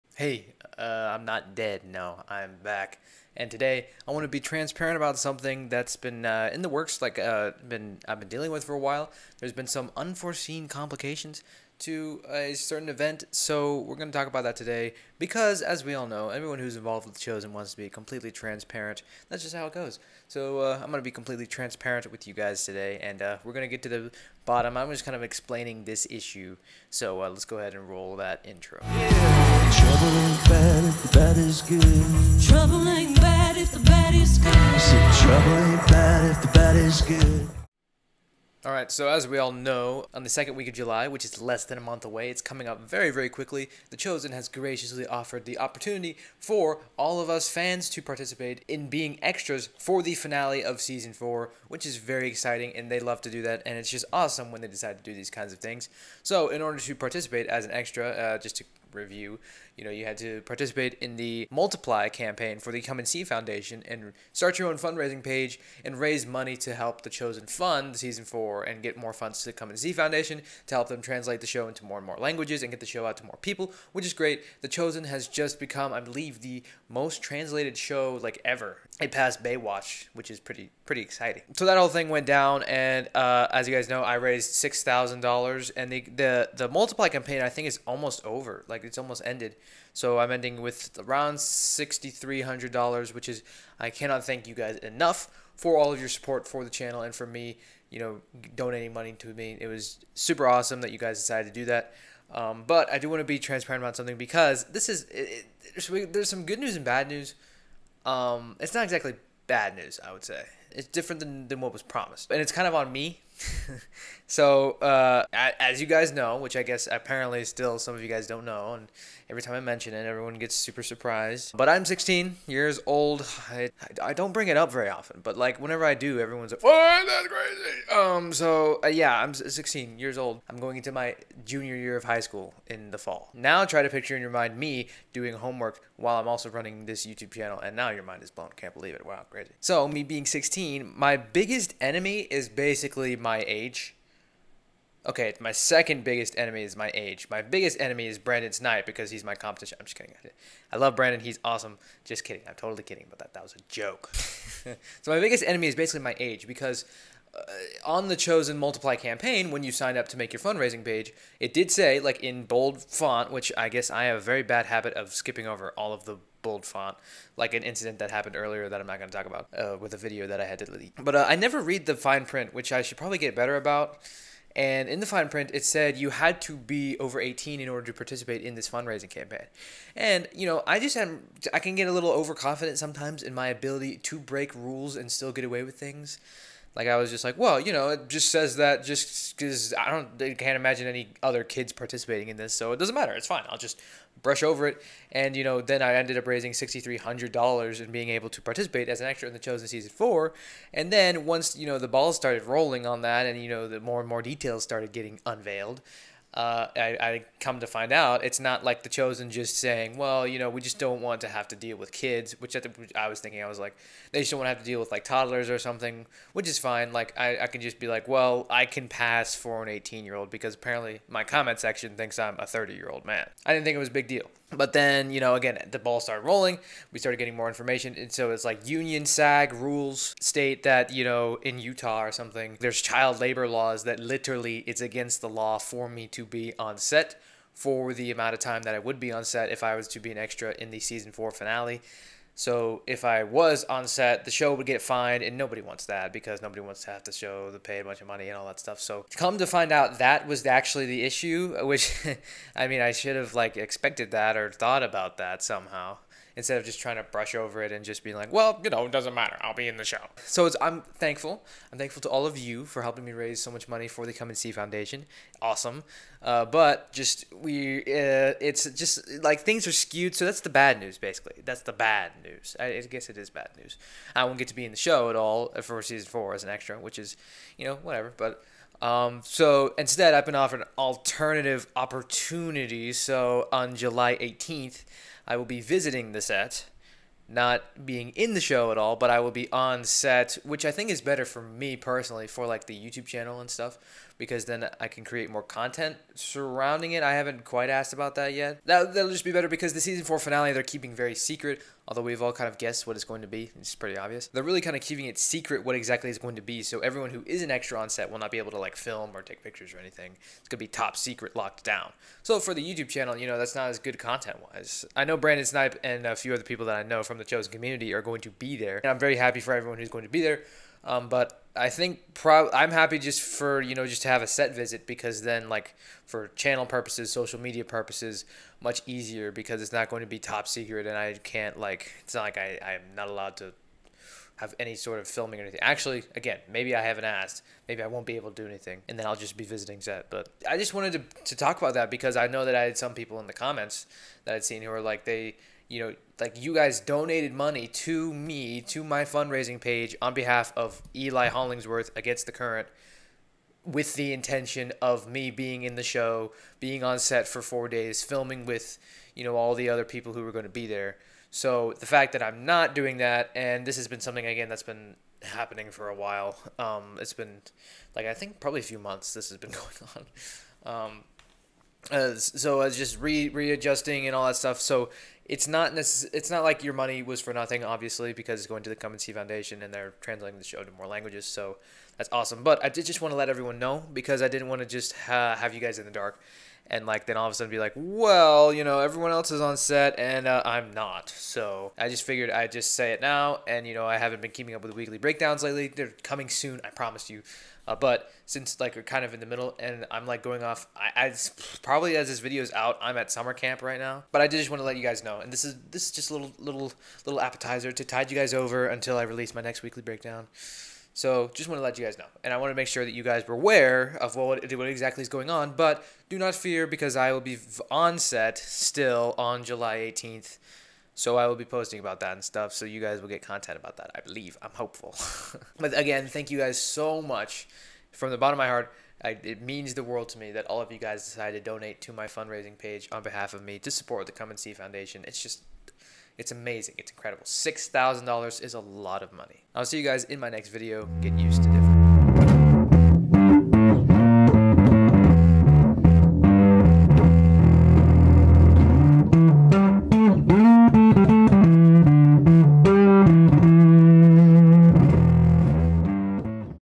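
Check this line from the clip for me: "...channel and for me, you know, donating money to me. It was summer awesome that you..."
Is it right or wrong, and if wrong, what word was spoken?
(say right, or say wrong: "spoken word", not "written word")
wrong: "super", not "summer".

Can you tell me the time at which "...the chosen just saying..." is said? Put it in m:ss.
3:28.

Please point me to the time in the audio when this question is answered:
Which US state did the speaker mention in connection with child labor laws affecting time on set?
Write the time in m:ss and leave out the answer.
3:51.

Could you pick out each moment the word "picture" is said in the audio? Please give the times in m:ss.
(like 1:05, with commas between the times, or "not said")
2:13, 5:09.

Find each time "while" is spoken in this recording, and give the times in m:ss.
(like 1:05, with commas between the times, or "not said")
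0:08, 2:15, 6:05.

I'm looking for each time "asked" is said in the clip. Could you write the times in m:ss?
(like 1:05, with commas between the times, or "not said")
4:57, 5:37.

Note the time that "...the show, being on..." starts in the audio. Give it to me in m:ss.
5:55.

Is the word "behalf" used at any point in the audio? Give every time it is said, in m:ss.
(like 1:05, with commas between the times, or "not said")
5:50, 7:13.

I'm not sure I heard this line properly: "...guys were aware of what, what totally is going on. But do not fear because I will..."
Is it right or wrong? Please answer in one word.
wrong.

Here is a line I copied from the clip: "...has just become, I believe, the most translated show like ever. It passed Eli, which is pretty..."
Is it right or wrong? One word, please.
wrong.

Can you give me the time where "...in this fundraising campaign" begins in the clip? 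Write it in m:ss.
2:58.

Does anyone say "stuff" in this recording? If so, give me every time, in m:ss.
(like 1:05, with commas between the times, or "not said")
4:08, 4:53, 6:14, 7:02.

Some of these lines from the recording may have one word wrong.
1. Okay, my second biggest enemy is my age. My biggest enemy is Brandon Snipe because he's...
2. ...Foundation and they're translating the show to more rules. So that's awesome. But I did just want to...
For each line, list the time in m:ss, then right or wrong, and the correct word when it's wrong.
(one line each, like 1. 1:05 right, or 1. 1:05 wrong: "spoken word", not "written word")
1. 2:25 right
2. 6:19 wrong: "languages", not "rules".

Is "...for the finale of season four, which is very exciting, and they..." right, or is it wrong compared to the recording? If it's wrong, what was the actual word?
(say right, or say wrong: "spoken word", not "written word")
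right.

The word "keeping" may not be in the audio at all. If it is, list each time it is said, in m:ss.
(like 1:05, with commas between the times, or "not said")
5:00, 5:04, 6:34.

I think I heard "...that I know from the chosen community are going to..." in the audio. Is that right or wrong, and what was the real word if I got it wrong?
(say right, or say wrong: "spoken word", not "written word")
right.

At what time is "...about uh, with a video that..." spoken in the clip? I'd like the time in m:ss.
2:49.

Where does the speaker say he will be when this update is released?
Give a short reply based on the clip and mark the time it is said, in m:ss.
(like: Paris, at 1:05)
summer camp, at 6:43.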